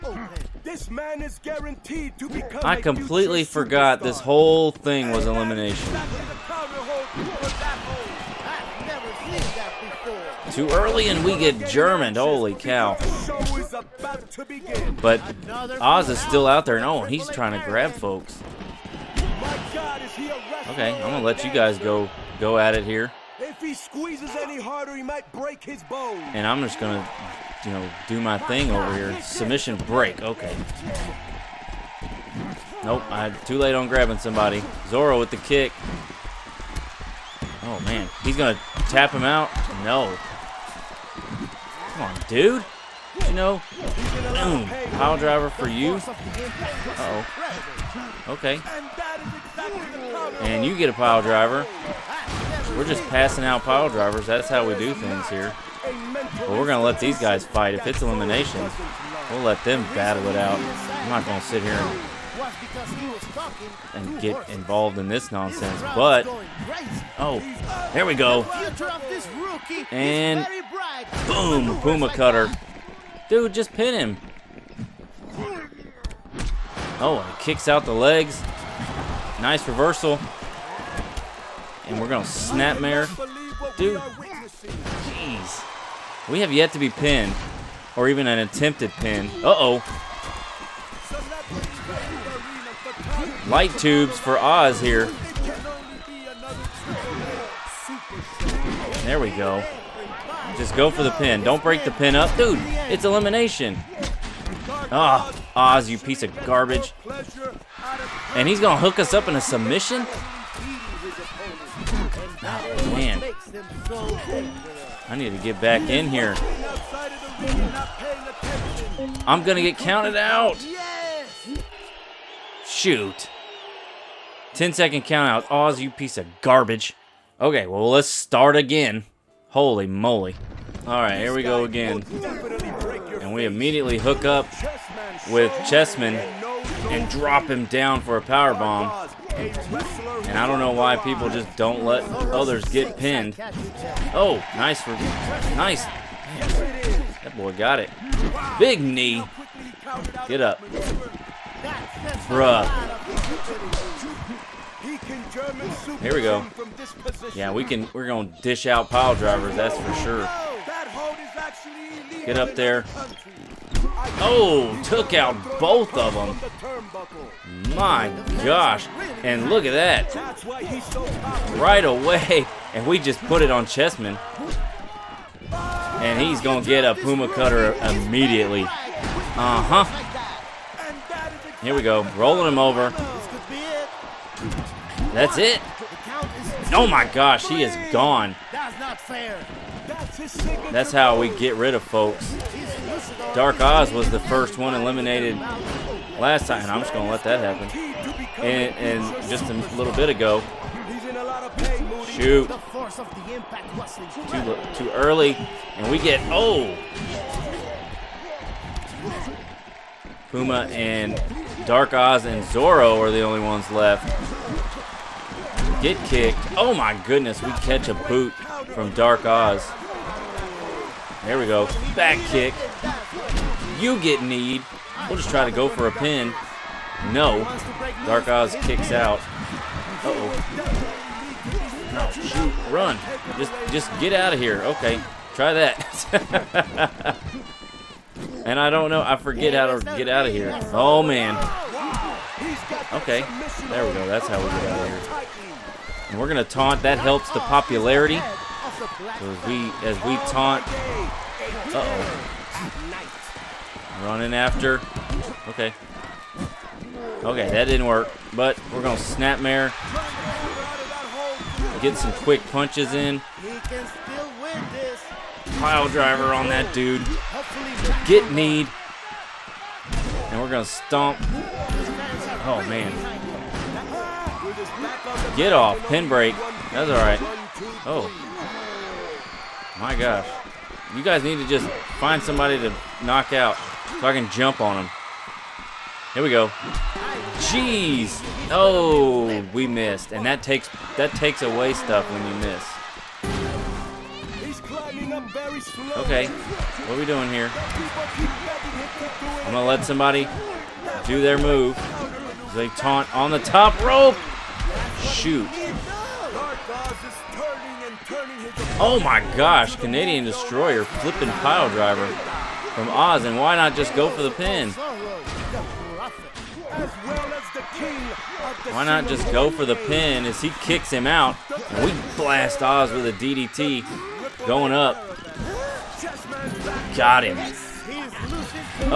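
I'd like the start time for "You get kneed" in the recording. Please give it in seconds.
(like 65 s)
223 s.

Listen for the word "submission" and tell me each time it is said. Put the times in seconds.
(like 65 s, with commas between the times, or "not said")
29 s, 109 s.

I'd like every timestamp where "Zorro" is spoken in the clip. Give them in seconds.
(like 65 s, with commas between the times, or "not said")
34 s, 212 s.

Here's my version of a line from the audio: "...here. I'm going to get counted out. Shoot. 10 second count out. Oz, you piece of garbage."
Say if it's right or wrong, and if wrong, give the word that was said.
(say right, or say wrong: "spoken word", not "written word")
right.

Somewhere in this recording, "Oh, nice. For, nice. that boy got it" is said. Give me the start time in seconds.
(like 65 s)
144 s.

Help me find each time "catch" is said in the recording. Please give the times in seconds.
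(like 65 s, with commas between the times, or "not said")
217 s.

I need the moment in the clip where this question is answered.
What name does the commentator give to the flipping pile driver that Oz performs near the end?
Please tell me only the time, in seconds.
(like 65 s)
309 s.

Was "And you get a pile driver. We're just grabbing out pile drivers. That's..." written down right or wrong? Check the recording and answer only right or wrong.
wrong.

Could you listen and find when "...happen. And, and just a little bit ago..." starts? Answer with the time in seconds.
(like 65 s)
197 s.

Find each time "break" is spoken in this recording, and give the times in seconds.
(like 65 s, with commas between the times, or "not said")
25 s, 29 s, 101 s, 276 s.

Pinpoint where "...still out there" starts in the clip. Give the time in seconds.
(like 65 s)
16 s.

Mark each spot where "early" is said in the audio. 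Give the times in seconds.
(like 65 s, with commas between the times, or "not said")
10 s, 204 s.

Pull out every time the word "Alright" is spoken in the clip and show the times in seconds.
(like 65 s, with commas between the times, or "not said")
130 s.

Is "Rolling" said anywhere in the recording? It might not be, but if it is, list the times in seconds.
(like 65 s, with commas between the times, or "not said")
182 s.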